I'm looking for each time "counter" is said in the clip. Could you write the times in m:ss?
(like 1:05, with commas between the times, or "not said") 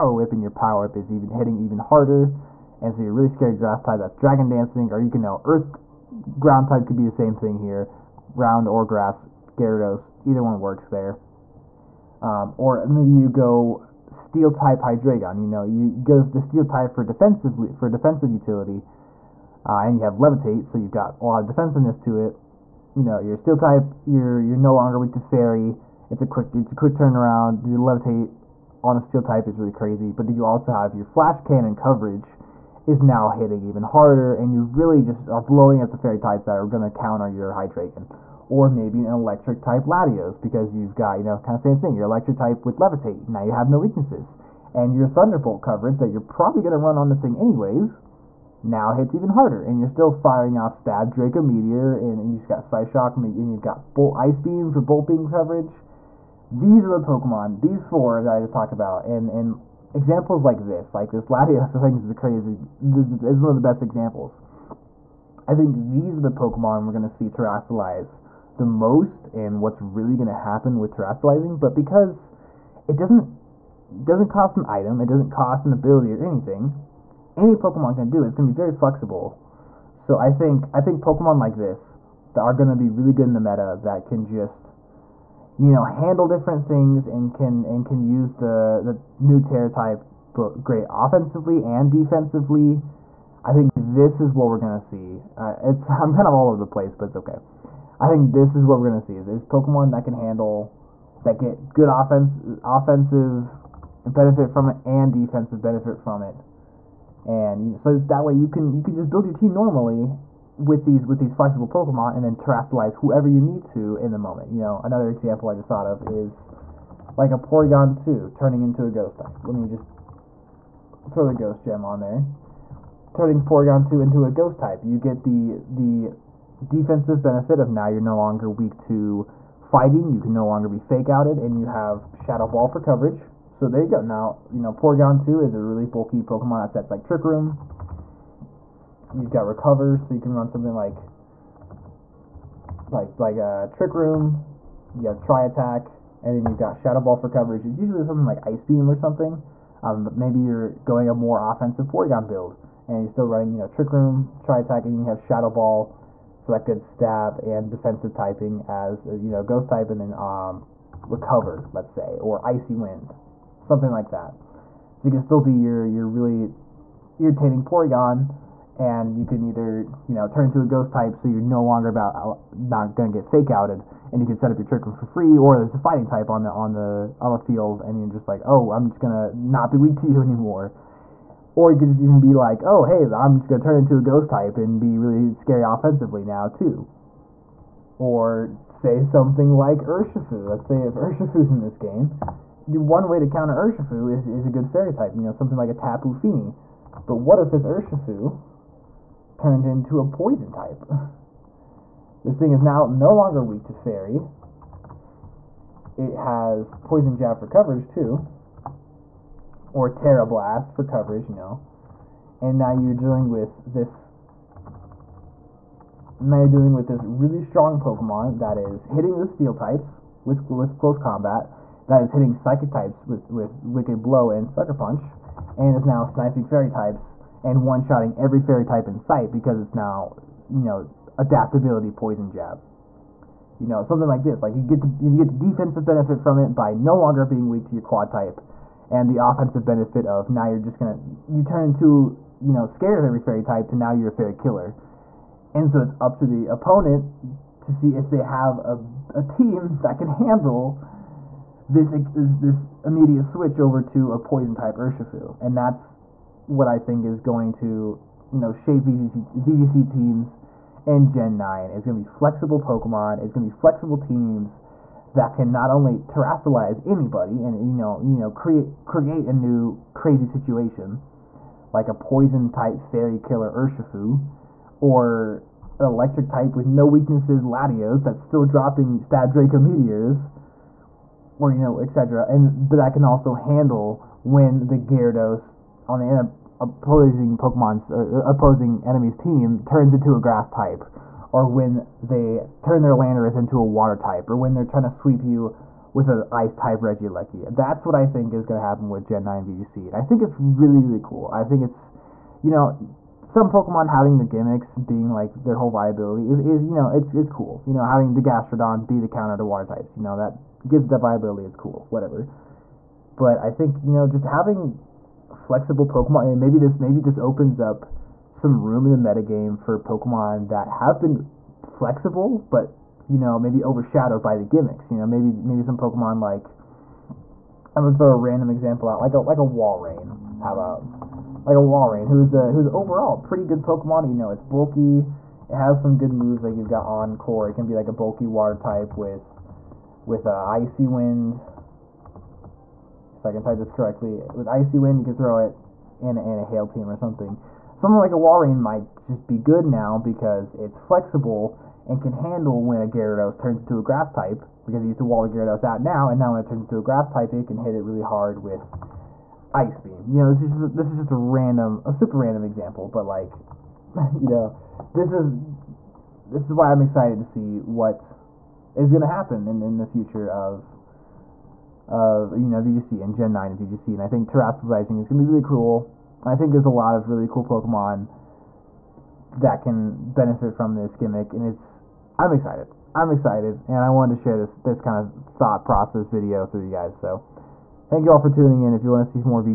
0:36, 3:13, 5:09.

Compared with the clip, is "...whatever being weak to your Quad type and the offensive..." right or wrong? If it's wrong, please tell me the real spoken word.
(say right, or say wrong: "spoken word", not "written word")
wrong: "longer", not "whatever".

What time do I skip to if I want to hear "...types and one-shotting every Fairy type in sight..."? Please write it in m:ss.
3:46.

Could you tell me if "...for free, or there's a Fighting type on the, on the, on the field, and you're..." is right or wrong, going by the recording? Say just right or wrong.
right.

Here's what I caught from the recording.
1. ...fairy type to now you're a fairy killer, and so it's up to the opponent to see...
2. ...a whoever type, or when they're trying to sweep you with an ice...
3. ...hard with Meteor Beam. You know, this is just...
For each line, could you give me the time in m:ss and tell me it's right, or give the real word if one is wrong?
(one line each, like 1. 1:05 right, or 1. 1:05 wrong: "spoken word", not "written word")
1. 4:03 right
2. 4:53 wrong: "water", not "whoever"
3. 5:58 wrong: "Ice", not "Meteor".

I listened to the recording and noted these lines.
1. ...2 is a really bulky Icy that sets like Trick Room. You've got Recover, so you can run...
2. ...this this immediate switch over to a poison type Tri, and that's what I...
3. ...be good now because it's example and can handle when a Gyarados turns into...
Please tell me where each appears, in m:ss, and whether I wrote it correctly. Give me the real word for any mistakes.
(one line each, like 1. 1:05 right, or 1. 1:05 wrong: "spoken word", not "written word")
1. 2:15 wrong: "Pokemon", not "Icy"
2. 4:11 wrong: "Urshifu", not "Tri"
3. 5:49 wrong: "flexible", not "example".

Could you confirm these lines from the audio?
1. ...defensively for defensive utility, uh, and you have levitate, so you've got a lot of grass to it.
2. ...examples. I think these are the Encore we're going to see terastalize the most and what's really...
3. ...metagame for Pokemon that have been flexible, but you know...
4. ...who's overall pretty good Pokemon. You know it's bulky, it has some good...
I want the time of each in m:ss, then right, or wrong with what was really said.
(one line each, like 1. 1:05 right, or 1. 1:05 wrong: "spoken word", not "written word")
1. 0:17 wrong: "defensiveness", not "grass"
2. 1:03 wrong: "Pokemon", not "Encore"
3. 5:19 right
4. 5:32 right.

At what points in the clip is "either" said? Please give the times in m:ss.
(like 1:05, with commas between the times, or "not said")
0:10, 2:49.